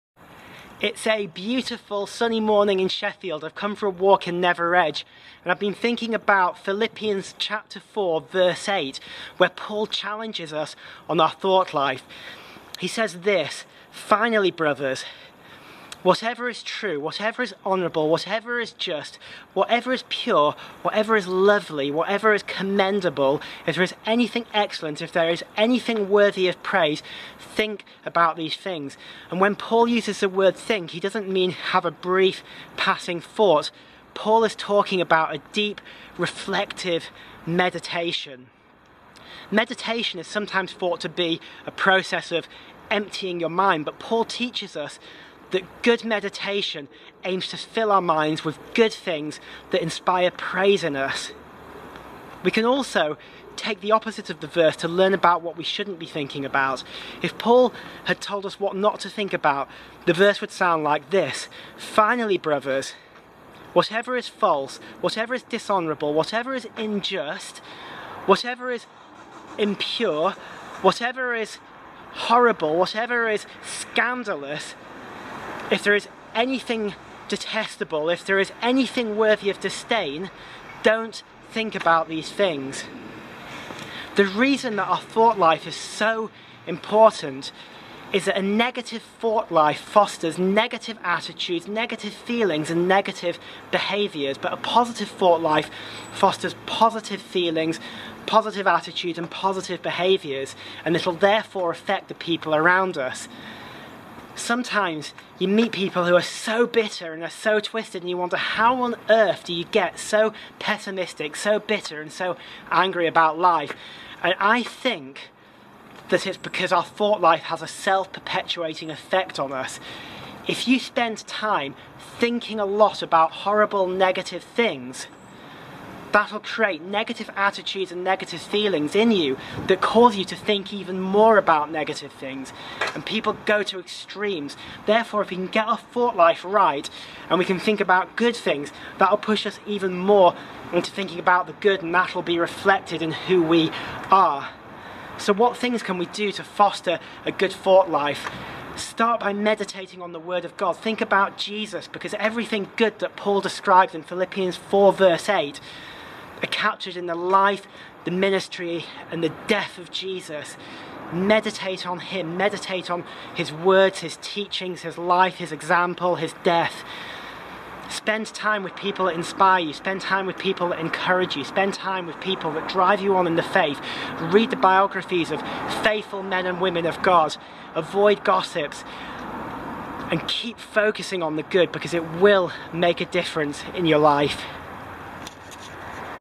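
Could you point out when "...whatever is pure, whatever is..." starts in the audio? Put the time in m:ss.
0:19.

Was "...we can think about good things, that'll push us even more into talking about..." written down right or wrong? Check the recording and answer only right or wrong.
wrong.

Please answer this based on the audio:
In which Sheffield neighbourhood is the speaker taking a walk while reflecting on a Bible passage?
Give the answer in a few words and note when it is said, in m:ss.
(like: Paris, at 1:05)
Nether Edge, at 0:04.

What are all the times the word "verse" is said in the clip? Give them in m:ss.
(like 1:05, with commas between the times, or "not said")
0:08, 0:54, 1:00, 2:34.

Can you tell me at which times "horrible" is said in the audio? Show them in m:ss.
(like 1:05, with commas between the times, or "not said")
1:12, 2:03.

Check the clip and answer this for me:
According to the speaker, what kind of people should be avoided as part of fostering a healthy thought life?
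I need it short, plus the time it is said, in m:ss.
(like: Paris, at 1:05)
Gossips, at 2:58.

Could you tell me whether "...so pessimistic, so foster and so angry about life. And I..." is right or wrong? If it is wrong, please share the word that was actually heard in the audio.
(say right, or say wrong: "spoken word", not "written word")
wrong: "bitter", not "foster".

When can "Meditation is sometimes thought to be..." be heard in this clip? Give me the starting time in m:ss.
0:39.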